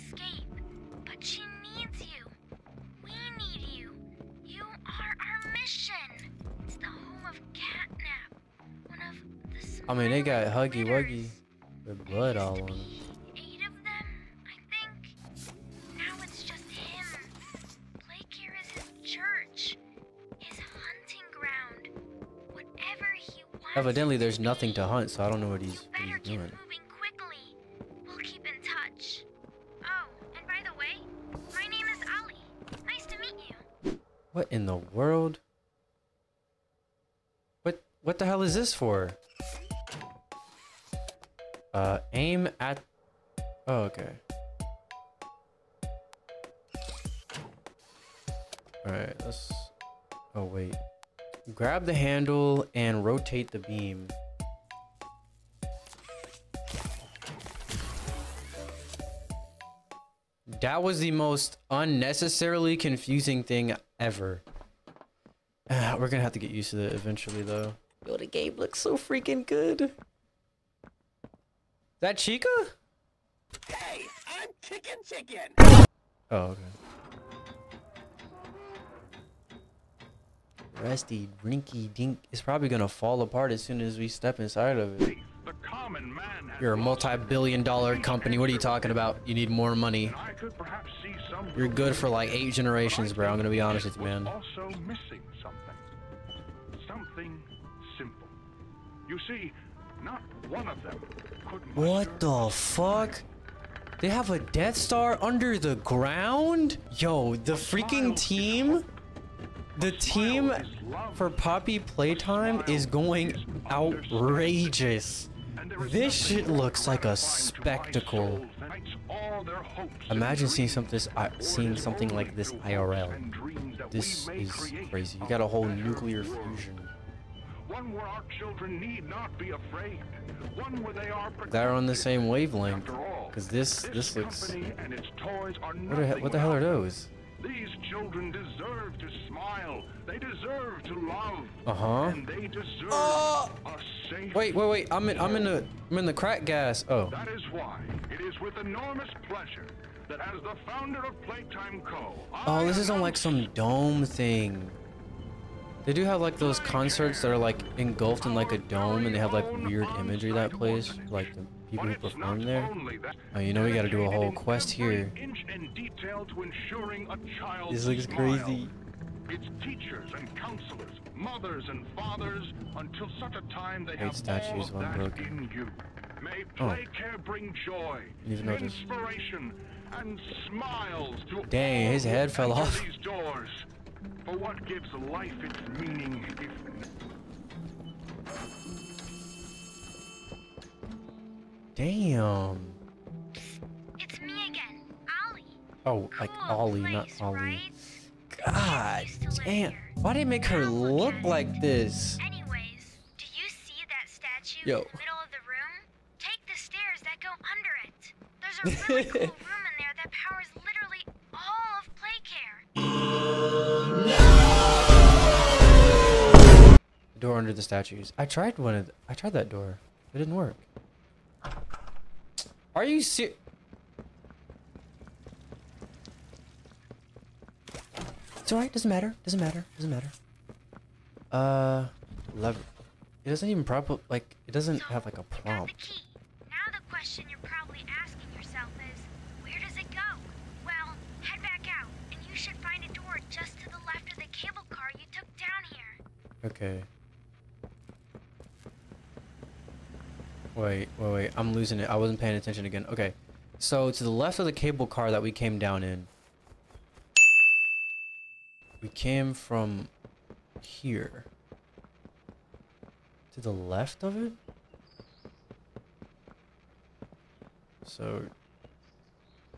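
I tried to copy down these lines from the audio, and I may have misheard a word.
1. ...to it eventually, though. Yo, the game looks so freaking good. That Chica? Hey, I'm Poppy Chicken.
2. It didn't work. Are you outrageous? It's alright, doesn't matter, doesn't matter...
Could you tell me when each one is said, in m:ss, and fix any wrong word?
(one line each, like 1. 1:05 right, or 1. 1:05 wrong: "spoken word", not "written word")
1. 1:06 wrong: "Chicken", not "Poppy"
2. 3:40 wrong: "serious", not "outrageous".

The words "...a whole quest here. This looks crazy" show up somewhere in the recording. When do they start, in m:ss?
2:44.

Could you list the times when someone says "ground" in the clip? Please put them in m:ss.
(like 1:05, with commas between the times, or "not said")
1:45.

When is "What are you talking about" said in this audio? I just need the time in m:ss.
1:28.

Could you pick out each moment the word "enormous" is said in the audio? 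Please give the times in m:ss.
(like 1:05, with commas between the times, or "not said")
2:28.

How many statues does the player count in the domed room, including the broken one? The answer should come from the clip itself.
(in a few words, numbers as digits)
8.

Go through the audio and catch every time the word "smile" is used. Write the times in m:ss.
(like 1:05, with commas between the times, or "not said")
2:19, 3:00.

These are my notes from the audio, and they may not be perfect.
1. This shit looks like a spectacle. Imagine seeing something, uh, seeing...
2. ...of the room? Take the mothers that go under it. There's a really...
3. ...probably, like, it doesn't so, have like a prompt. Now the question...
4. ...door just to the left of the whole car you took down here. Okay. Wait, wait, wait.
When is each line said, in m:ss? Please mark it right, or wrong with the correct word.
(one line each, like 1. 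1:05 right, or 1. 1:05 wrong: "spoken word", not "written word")
1. 1:55 right
2. 3:25 wrong: "stairs", not "mothers"
3. 3:53 right
4. 4:02 wrong: "cable", not "whole".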